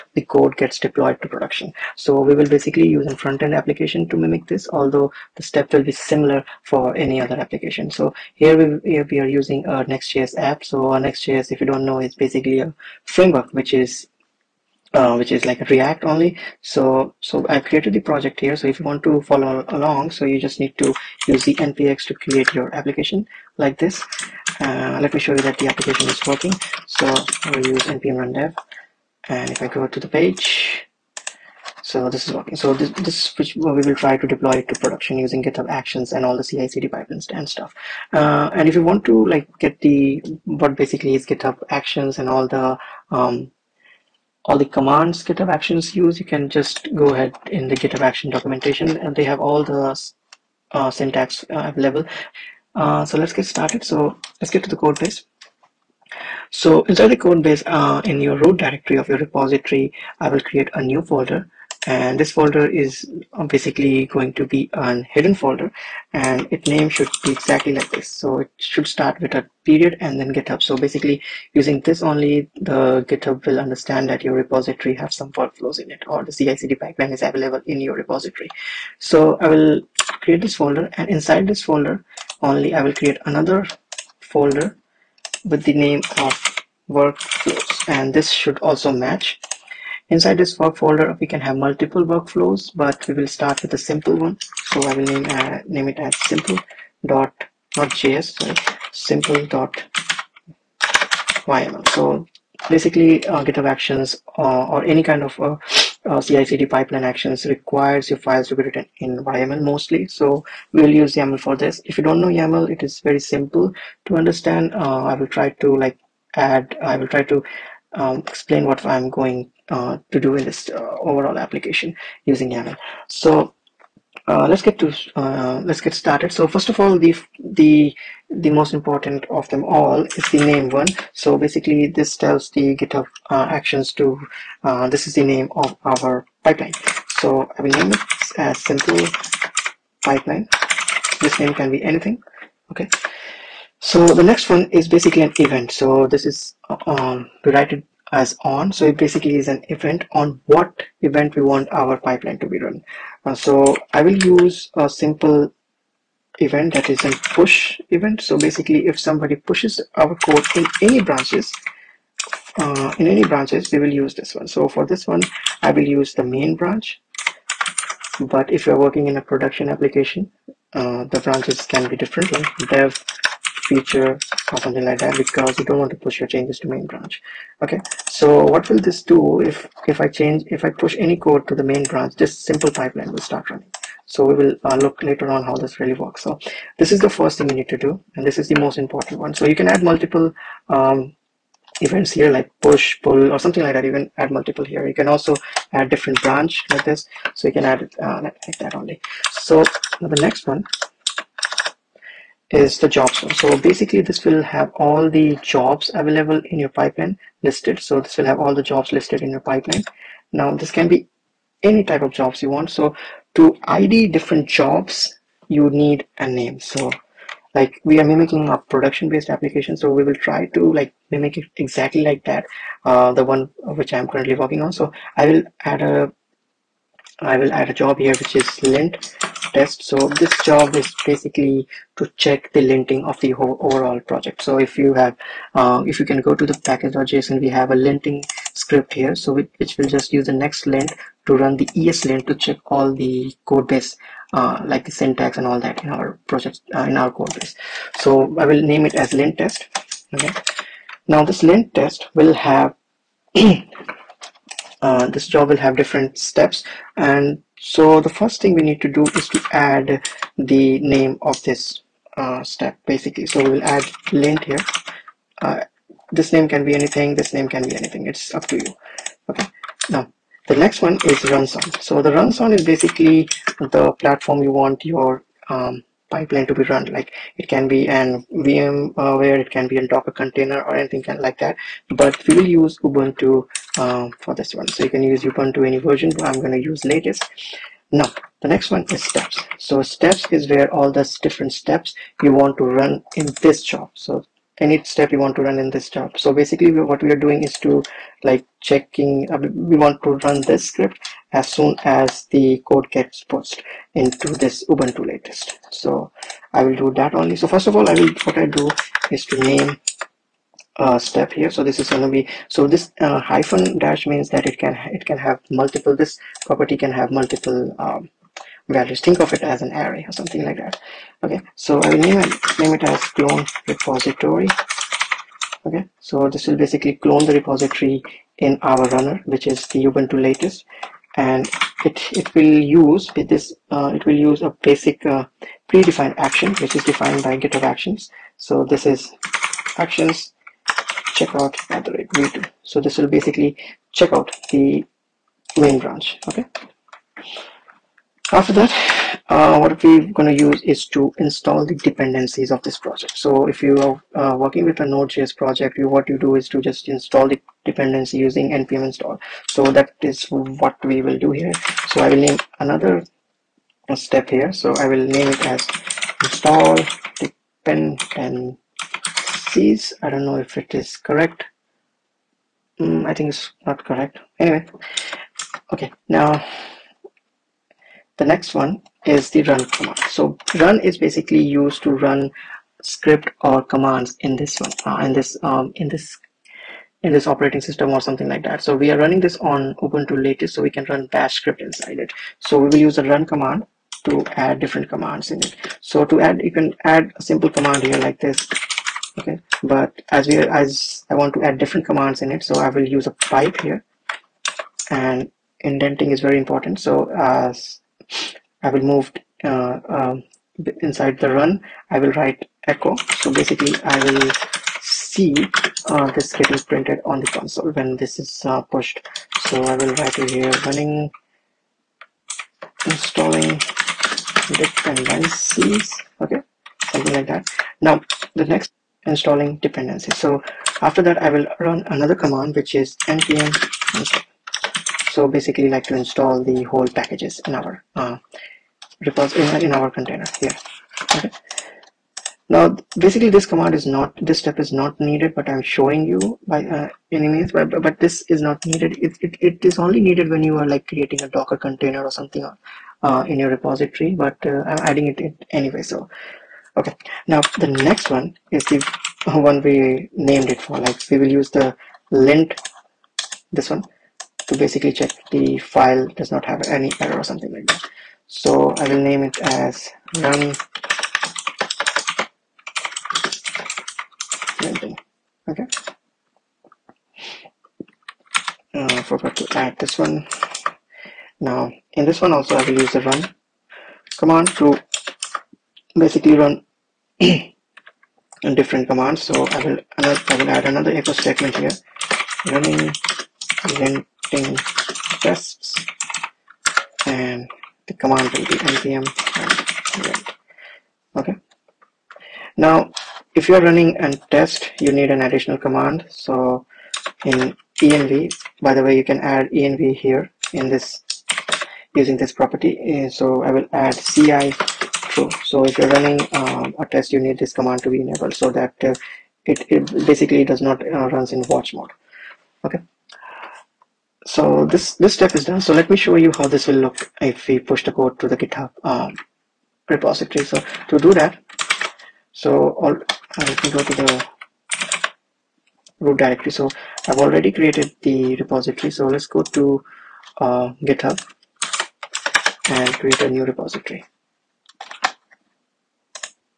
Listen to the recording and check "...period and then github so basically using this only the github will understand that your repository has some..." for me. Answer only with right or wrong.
right.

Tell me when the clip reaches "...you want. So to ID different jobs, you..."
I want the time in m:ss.
3:32.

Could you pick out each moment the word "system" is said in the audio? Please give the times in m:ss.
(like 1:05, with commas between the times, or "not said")
6:27.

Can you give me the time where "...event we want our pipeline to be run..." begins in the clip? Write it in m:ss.
2:31.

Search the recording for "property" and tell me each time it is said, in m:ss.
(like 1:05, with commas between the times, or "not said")
5:16, 8:32.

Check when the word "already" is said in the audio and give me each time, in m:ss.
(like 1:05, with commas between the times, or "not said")
8:57.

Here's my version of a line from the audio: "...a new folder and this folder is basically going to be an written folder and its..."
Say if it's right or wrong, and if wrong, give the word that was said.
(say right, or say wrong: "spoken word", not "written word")
wrong: "hidden", not "written".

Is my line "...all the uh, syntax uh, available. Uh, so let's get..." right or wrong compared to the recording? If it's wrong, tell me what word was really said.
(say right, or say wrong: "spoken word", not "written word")
right.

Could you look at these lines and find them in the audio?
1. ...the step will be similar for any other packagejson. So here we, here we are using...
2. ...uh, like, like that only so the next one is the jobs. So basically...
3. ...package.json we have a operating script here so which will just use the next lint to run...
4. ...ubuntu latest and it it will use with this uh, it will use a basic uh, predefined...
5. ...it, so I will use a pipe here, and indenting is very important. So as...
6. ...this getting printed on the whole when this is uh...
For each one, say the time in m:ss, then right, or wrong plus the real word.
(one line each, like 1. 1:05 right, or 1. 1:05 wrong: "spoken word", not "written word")
1. 0:05 wrong: "application", not "packagejson"
2. 3:18 right
3. 3:56 wrong: "linting", not "operating"
4. 5:29 right
5. 6:42 right
6. 6:56 wrong: "console", not "whole".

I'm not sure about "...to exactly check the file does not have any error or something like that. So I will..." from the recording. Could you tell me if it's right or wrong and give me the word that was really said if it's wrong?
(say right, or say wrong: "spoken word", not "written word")
wrong: "basically", not "exactly".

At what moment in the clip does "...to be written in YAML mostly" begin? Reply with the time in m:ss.
1:48.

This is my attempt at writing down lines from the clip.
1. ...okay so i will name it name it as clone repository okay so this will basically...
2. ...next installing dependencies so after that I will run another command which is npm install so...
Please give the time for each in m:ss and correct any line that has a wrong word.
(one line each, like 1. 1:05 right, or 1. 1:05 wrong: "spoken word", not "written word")
1. 5:21 right
2. 7:08 right.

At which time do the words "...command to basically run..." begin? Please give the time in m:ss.
8:04.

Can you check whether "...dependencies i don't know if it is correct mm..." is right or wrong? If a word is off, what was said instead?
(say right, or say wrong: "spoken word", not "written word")
right.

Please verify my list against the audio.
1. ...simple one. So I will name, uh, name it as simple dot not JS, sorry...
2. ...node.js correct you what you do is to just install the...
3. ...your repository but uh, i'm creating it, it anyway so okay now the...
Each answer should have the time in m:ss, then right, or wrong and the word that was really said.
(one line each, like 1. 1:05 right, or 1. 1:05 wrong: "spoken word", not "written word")
1. 1:33 right
2. 5:54 wrong: "project", not "correct"
3. 7:33 wrong: "adding", not "creating".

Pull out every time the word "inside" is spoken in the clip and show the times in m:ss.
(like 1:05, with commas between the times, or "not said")
0:56, 1:21, 1:30, 6:31, 6:50.